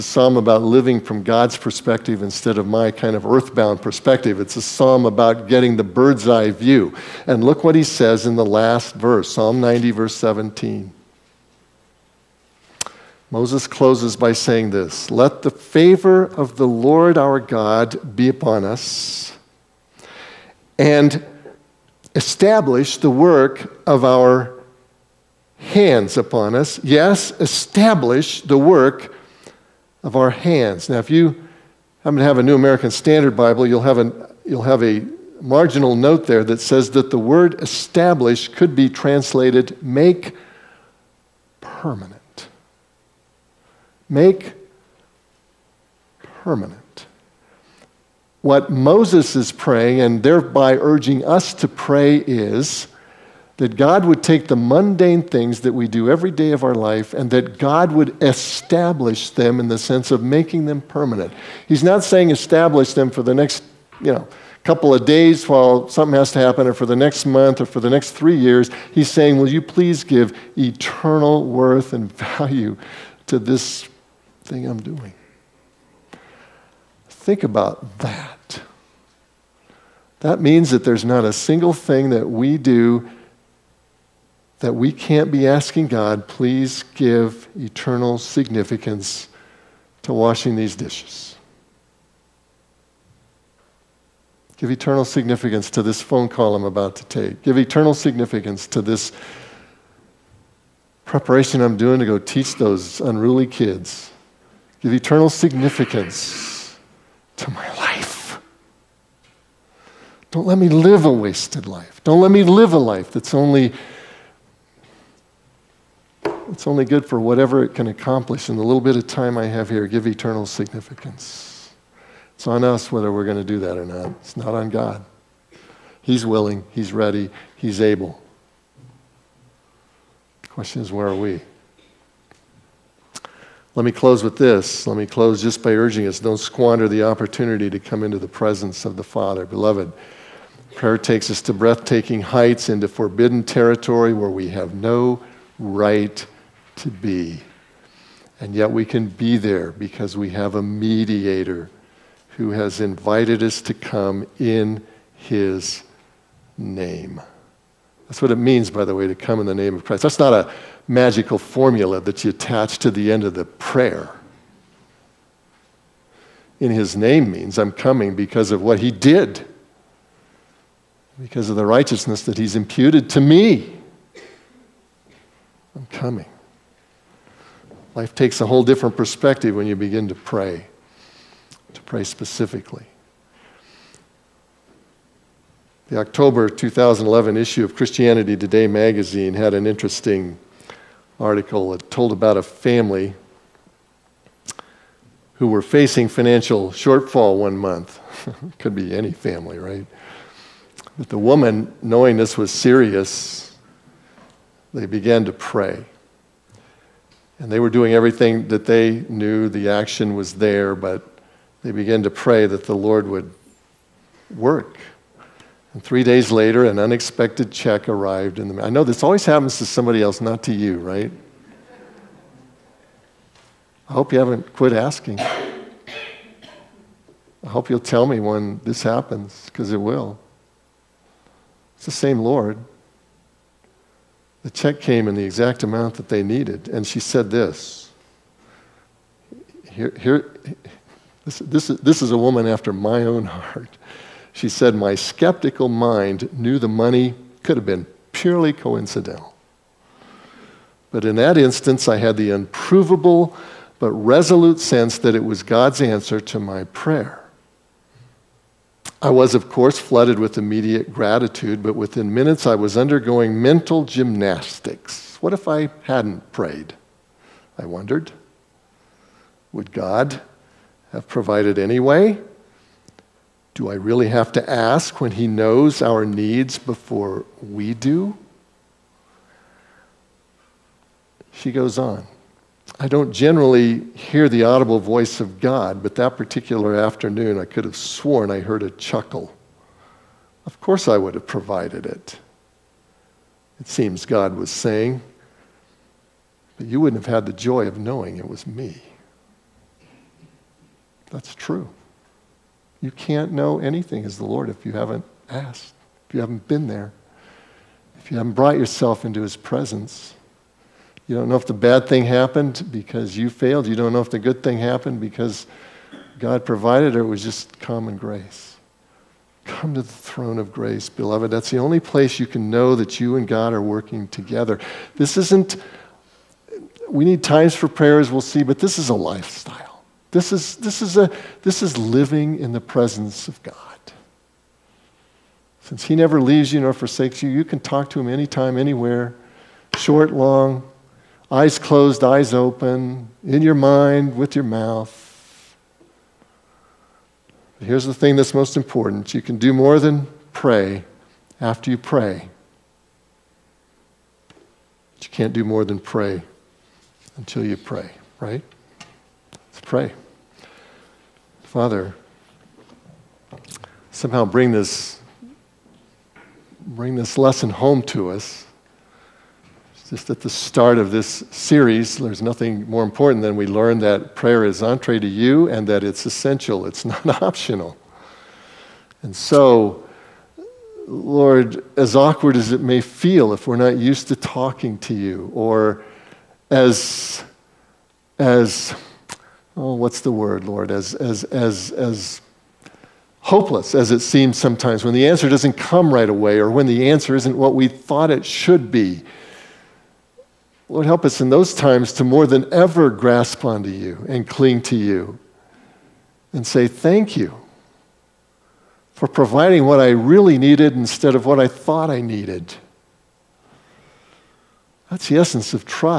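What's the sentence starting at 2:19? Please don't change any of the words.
Beloved, prayer takes us to breathtaking heights, into forbidden territory where we have no right to be.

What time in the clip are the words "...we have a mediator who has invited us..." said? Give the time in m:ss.
2:30.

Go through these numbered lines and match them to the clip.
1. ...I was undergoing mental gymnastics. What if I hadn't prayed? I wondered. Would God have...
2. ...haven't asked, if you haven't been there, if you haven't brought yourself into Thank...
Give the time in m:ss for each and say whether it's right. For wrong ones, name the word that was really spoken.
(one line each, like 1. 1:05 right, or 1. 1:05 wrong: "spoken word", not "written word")
1. 4:22 right
2. 5:04 wrong: "His", not "Thank".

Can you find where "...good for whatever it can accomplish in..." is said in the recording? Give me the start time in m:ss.
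1:56.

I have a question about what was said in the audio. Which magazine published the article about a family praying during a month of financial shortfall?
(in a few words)
Christianity Today.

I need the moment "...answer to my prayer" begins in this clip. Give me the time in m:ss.
4:15.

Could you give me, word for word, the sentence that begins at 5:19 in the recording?
Come to the throne of grace, beloved.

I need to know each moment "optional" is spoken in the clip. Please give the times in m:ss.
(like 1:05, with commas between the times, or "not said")
6:17.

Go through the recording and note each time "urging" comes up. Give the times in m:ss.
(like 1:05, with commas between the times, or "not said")
0:50, 2:15.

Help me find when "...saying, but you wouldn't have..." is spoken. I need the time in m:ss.
4:54.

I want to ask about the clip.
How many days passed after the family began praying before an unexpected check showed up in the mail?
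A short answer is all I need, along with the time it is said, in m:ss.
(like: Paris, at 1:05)
3, at 3:35.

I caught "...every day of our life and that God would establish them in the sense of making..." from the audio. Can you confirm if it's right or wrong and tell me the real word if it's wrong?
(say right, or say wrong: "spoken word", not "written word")
right.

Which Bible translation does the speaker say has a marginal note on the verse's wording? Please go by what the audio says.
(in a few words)
New American Standard Bible.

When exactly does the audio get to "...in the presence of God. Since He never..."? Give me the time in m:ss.
5:32.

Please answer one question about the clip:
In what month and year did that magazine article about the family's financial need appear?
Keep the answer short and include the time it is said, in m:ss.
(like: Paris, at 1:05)
October 2011, at 3:05.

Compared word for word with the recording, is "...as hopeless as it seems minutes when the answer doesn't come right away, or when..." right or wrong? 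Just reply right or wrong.
wrong.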